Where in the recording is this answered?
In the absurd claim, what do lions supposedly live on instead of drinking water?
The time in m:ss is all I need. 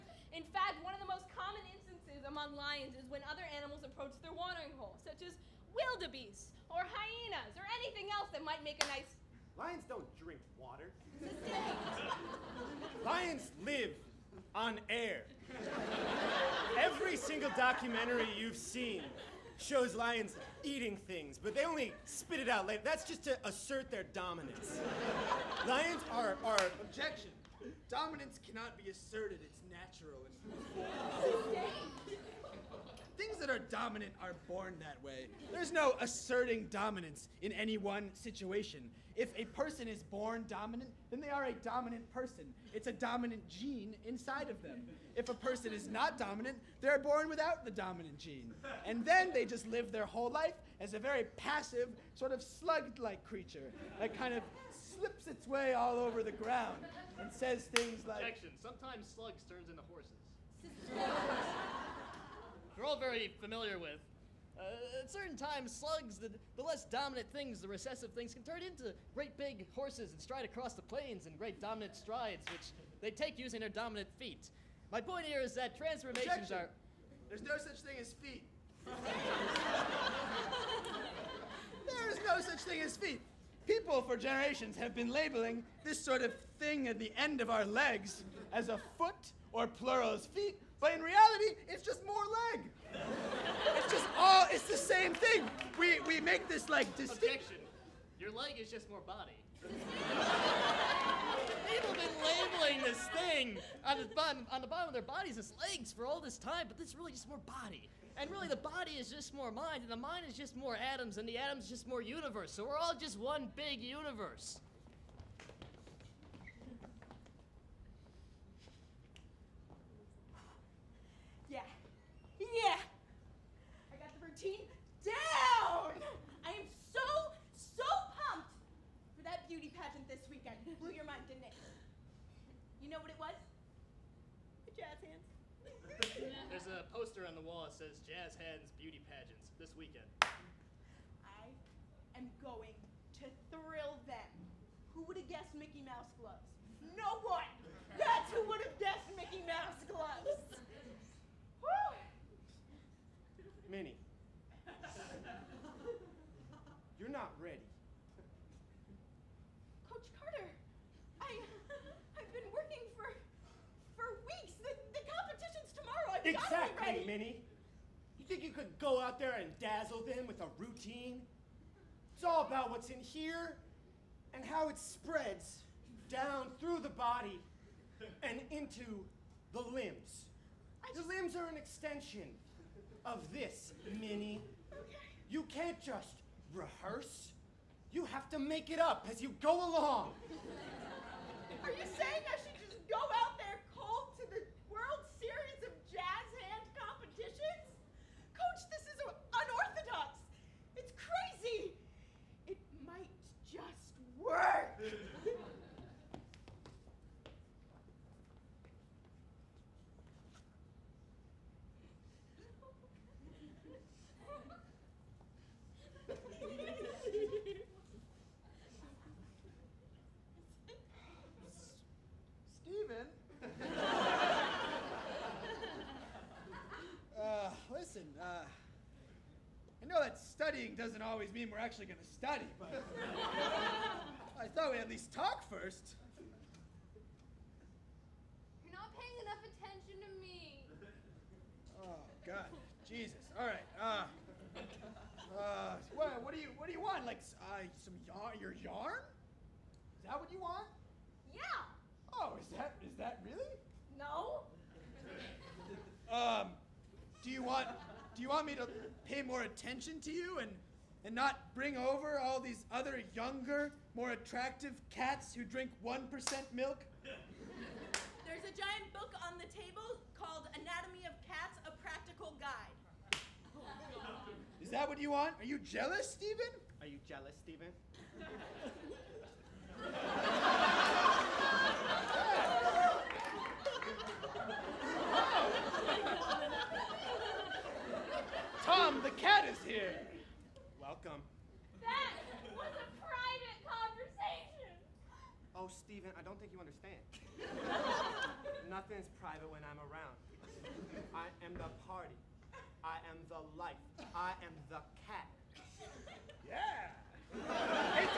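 0:13.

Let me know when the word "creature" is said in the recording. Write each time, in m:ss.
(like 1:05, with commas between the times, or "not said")
0:53.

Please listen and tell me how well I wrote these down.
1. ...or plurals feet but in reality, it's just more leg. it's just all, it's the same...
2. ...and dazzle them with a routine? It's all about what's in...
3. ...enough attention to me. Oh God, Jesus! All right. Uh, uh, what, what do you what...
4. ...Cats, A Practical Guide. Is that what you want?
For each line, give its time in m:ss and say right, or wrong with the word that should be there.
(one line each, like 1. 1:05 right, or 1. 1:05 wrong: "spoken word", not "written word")
1. 1:29 right
2. 2:49 right
3. 3:59 right
4. 4:31 right.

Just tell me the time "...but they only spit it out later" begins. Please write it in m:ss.
0:21.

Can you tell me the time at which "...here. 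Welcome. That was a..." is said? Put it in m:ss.
4:49.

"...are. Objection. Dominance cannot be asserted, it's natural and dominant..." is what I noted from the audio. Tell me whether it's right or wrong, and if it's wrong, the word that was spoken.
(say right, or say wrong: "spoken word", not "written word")
right.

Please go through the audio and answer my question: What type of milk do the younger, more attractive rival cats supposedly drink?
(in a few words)
1% milk.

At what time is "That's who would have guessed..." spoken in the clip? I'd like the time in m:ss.
2:27.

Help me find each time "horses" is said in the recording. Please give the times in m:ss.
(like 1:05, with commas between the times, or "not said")
0:59, 1:09.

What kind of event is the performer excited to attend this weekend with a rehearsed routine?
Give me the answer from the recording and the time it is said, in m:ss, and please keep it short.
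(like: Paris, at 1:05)
Beauty pageant, at 2:09.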